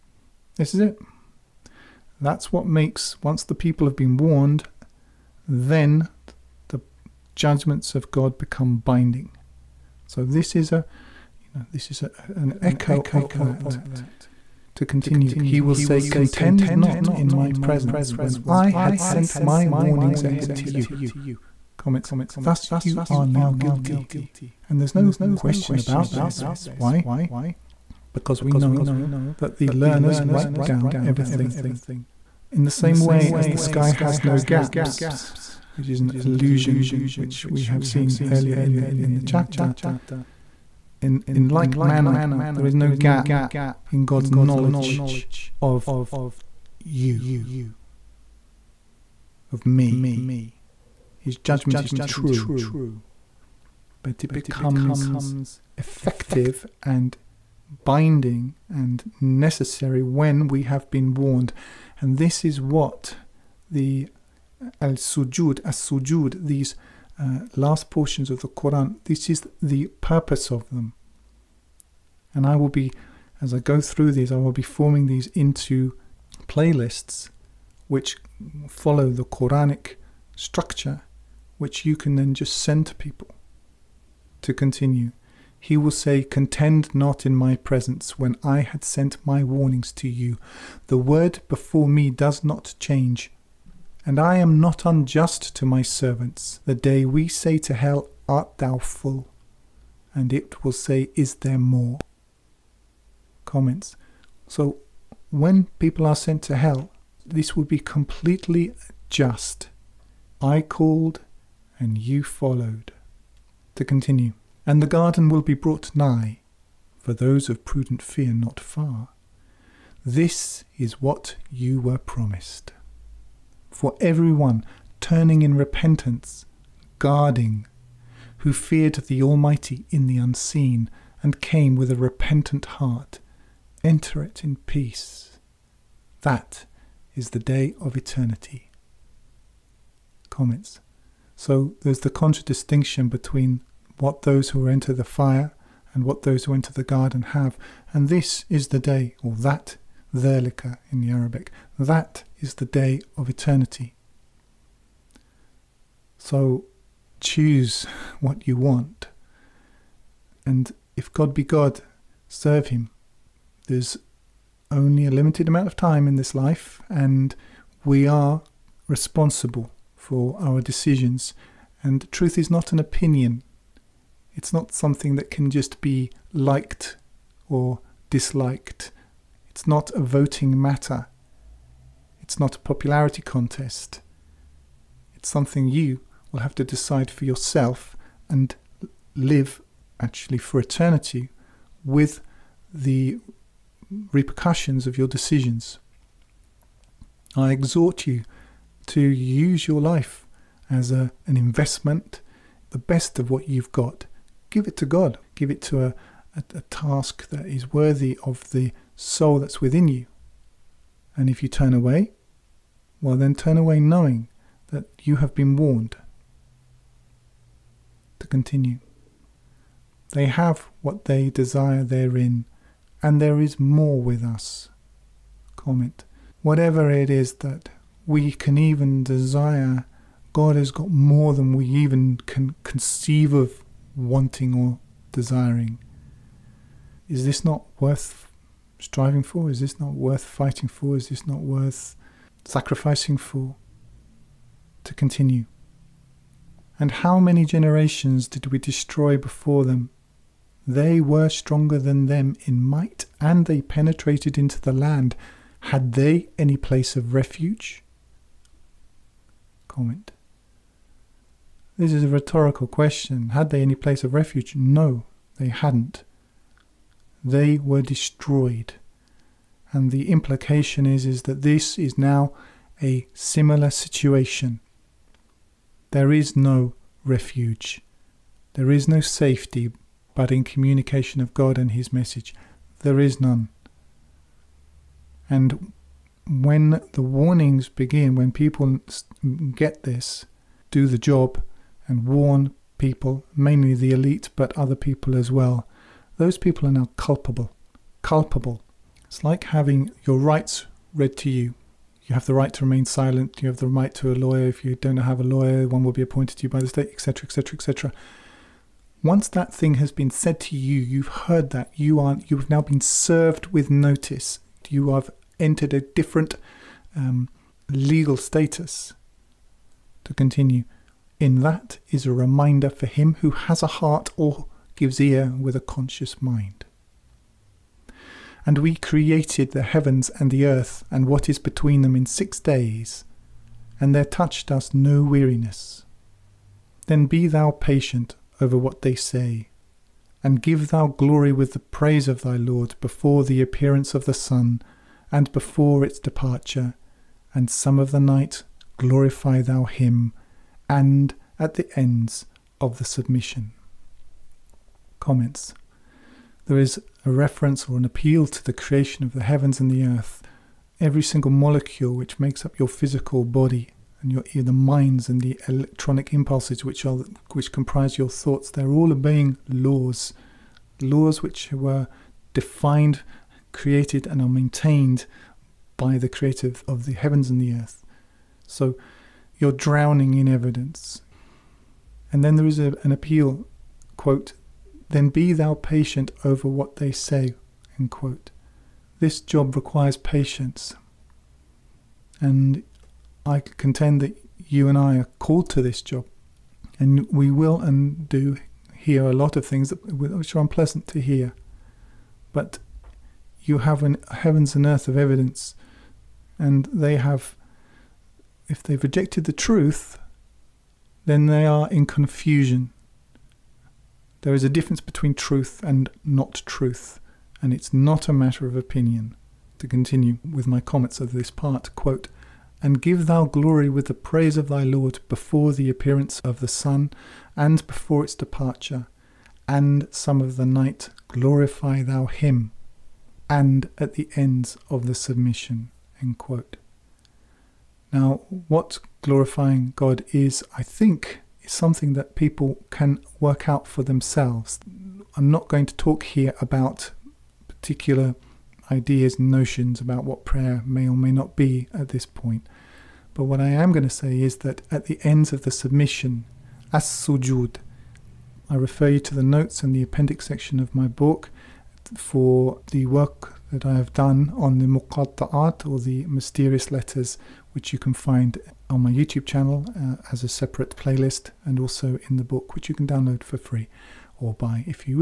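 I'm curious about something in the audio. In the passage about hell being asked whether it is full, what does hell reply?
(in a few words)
Is there more?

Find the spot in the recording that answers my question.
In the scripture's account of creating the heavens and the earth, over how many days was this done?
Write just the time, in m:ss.
5:32.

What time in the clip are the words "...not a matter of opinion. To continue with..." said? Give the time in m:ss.
6:57.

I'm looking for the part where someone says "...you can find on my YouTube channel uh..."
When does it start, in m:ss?
7:47.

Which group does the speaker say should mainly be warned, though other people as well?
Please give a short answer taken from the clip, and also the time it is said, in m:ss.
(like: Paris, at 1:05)
the elite, at 4:53.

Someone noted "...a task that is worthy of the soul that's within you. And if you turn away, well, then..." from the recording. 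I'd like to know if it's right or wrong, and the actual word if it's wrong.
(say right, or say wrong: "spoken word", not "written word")
right.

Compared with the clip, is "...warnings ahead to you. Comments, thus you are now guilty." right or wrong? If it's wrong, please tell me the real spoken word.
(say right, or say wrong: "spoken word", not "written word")
right.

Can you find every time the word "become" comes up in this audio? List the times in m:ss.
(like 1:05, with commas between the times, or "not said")
0:08, 0:54.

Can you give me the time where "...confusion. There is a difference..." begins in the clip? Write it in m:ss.
6:51.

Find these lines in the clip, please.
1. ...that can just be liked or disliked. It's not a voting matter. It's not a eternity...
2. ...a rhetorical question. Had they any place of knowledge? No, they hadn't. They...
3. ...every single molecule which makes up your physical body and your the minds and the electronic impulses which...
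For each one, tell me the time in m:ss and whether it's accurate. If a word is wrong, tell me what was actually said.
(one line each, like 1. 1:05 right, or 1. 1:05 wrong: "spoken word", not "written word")
1. 2:55 wrong: "popularity", not "eternity"
2. 4:22 wrong: "refuge", not "knowledge"
3. 6:00 right.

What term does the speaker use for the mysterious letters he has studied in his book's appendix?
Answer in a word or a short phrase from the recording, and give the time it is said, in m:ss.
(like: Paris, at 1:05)
muqatta'at, at 7:44.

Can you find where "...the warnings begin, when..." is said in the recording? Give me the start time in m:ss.
4:46.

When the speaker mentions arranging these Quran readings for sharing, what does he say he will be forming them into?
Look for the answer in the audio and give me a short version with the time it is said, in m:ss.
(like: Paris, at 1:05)
playlists, at 1:16.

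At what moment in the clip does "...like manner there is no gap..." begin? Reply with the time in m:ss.
0:41.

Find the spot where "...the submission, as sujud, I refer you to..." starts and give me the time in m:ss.
7:35.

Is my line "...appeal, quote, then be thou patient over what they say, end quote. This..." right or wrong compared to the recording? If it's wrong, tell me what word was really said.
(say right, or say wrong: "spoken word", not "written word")
right.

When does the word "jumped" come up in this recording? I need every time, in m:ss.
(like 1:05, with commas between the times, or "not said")
not said.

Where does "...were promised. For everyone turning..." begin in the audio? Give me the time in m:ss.
2:01.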